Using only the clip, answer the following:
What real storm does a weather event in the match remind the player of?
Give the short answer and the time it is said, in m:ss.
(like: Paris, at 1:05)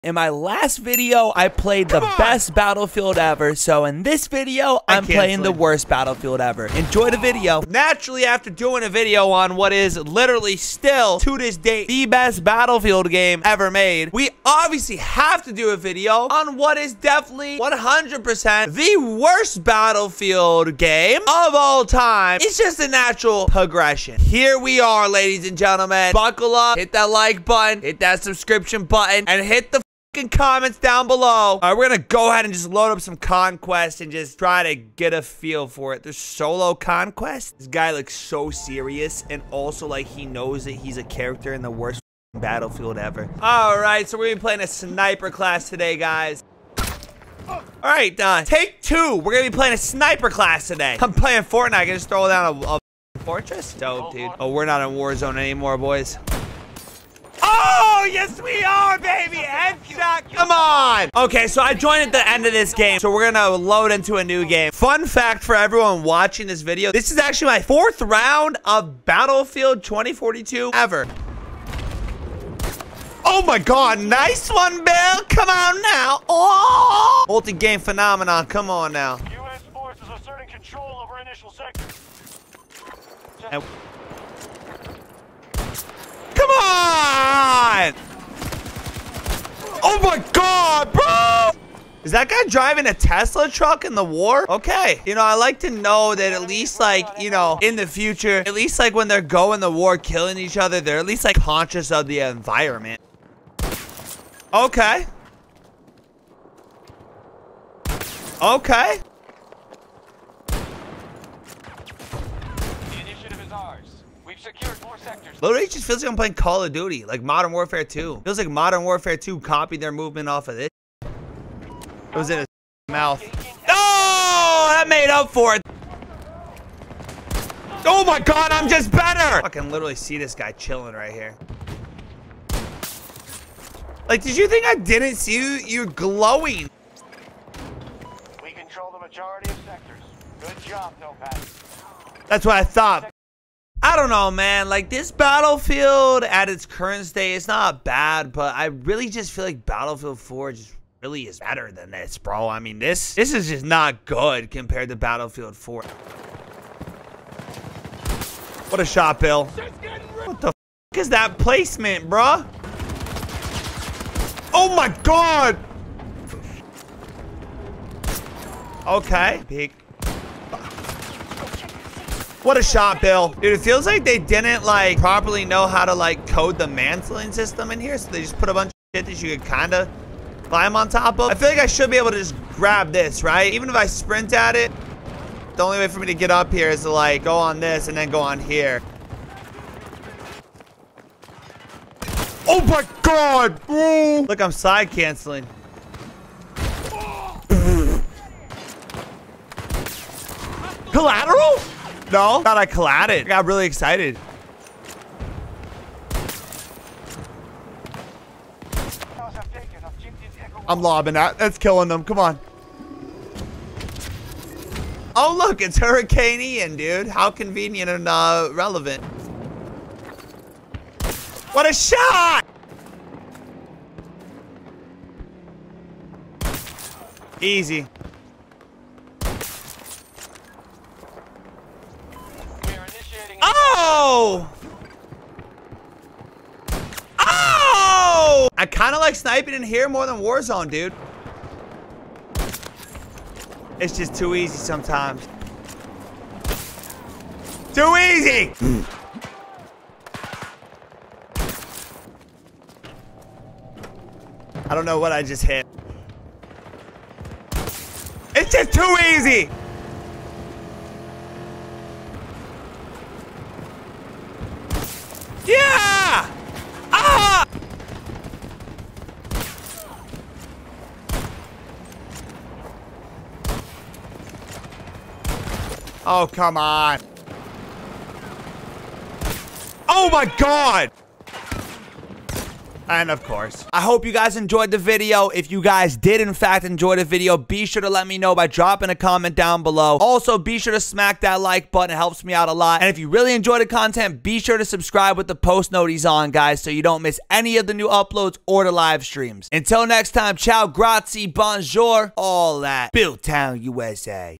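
Hurricane Ian, at 3:35.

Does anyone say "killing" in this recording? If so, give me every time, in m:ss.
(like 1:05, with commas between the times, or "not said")
1:39, 3:31.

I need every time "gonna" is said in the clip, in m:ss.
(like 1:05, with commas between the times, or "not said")
0:31, 0:44, 0:49.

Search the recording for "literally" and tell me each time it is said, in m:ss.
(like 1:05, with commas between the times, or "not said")
0:09, 1:55, 2:09.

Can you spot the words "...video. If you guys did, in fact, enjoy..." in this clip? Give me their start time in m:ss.
4:44.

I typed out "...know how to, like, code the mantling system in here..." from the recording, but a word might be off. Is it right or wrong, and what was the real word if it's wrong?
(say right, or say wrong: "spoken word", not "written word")
right.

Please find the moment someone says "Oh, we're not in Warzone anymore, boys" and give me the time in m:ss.
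0:54.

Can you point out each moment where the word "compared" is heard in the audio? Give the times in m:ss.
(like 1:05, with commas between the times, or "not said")
2:34.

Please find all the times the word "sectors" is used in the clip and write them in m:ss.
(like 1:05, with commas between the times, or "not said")
1:21, 1:54, 2:19.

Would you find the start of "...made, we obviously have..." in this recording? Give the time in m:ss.
0:13.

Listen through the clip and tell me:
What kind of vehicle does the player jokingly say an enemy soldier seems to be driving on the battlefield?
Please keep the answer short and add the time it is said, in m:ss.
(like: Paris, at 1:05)
Tesla truck, at 1:32.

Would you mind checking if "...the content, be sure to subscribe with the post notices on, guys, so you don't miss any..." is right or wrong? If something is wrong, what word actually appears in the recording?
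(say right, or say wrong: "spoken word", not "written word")
right.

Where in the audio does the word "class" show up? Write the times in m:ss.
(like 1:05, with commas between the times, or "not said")
0:45, 0:50.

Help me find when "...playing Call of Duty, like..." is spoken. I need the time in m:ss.
1:56.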